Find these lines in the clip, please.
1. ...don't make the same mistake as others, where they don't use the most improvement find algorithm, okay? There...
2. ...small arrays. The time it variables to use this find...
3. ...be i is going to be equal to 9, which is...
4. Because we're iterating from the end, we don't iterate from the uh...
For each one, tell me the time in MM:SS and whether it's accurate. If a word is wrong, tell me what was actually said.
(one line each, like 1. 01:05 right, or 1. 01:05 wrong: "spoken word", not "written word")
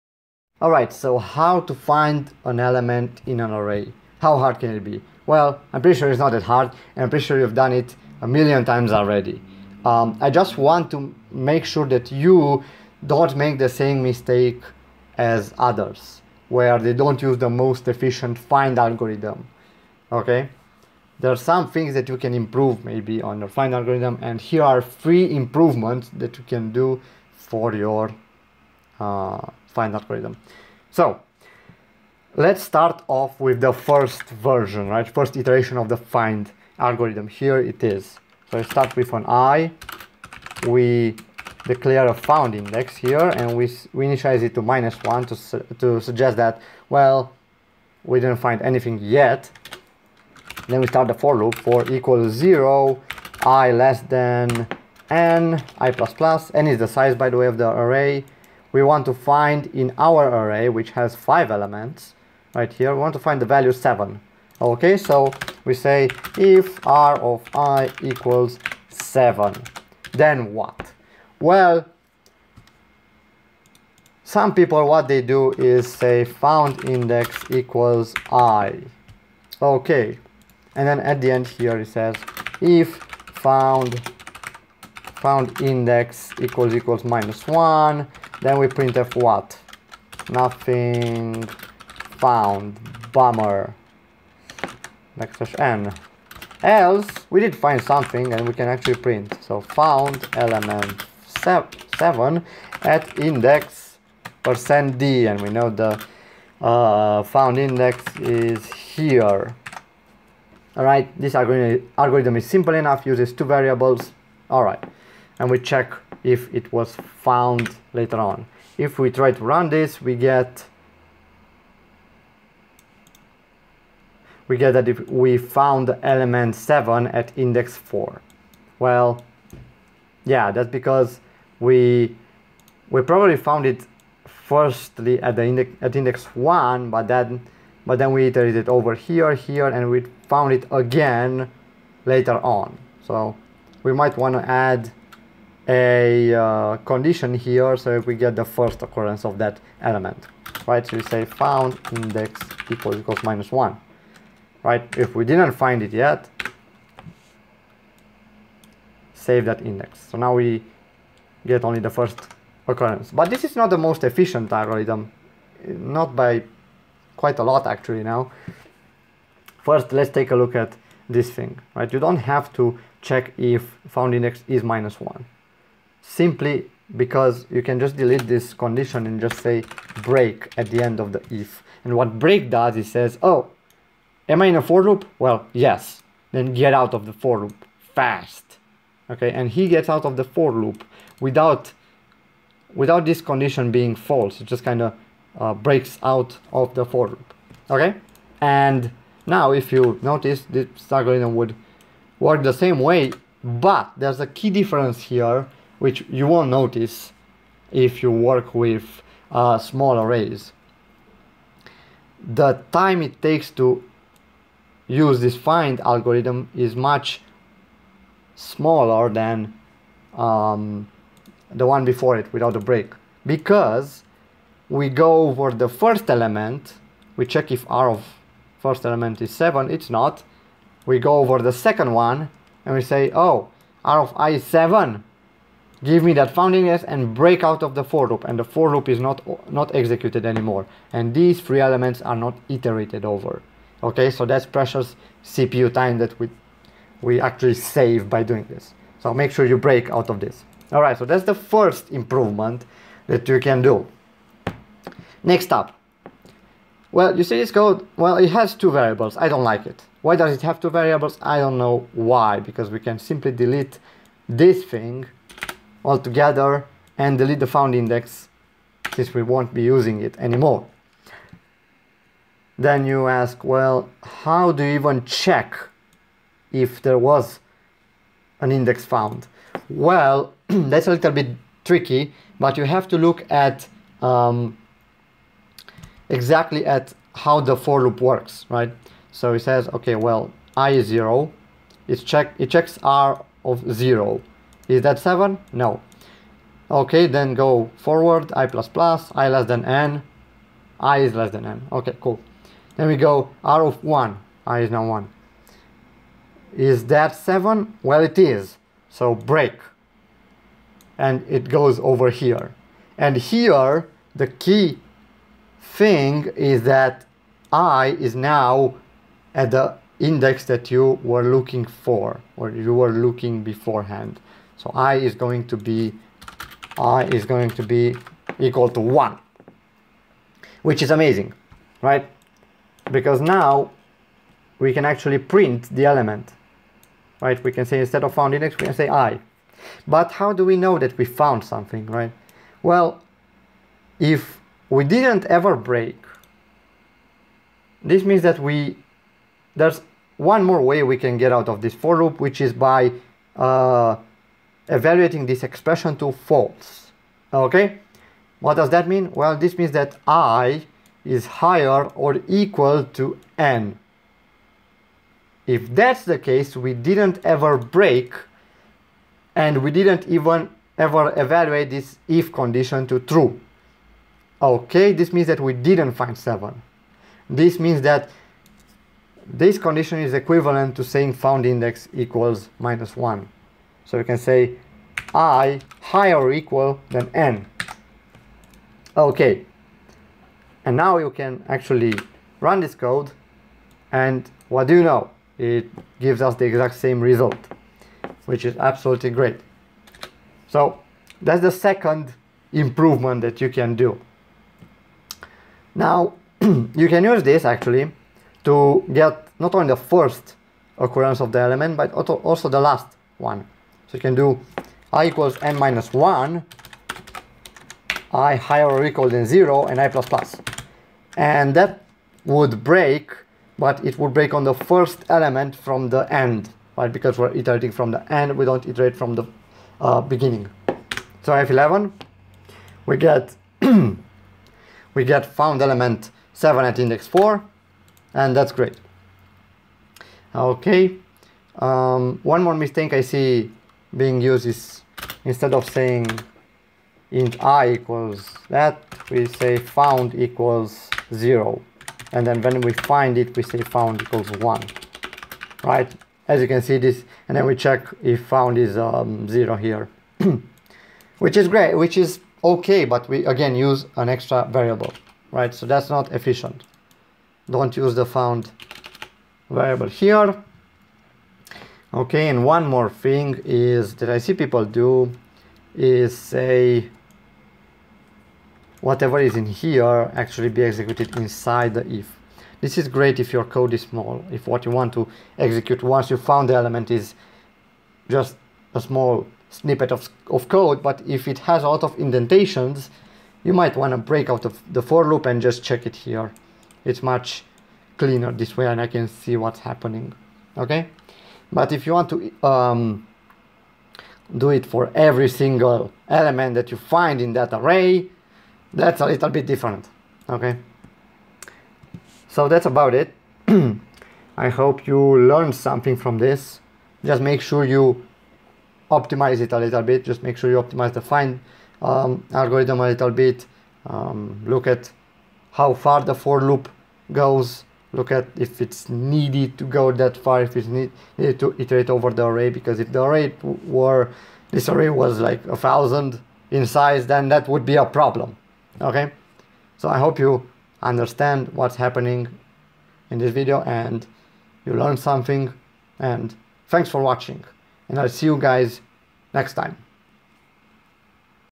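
1. 00:13 wrong: "efficient", not "improvement"
2. 03:29 wrong: "takes", not "variables"
3. 05:25 wrong: "1", not "9"
4. 07:06 right.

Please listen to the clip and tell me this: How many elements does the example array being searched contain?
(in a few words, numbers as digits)
5.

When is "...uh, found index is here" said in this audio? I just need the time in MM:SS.
01:46.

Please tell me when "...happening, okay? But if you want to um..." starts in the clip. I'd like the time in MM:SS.
08:19.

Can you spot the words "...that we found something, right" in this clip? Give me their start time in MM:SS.
05:40.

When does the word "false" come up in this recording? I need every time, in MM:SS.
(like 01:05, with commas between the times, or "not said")
03:13, 05:56.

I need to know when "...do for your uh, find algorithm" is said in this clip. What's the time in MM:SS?
00:26.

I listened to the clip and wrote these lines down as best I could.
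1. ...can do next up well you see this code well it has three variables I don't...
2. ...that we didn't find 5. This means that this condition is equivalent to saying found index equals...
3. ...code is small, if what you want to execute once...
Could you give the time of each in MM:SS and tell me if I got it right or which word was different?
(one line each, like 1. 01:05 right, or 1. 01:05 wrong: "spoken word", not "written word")
1. 04:13 wrong: "two", not "three"
2. 06:15 wrong: "7", not "5"
3. 08:03 right.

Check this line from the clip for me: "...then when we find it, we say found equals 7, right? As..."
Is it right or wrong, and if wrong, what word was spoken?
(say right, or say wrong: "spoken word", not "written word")
wrong: "1", not "7".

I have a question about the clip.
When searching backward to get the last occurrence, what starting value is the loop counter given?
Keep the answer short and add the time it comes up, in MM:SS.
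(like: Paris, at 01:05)
n minus 1, at 06:55.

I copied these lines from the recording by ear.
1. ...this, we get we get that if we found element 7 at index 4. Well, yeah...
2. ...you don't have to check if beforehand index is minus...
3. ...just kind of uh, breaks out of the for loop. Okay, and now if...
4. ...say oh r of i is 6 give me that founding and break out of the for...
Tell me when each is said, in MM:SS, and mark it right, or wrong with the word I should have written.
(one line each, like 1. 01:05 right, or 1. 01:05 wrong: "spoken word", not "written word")
1. 01:59 right
2. 02:51 wrong: "found", not "beforehand"
3. 03:14 right
4. 03:52 wrong: "7", not "6".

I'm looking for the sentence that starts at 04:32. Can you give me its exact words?
Then you ask, well, how do you even check if there was an index found?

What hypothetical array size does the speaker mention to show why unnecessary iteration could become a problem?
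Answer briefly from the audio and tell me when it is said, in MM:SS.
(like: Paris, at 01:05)
a thousand, at 08:55.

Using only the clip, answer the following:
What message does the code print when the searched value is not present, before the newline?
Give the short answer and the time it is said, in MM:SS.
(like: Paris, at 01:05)
Nothing found. Bummer., at 01:30.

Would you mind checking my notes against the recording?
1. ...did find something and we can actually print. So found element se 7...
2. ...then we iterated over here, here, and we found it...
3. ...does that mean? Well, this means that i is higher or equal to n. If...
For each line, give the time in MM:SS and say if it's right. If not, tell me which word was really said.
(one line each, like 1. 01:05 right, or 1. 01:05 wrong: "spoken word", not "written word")
1. 01:37 right
2. 02:17 right
3. 05:58 right.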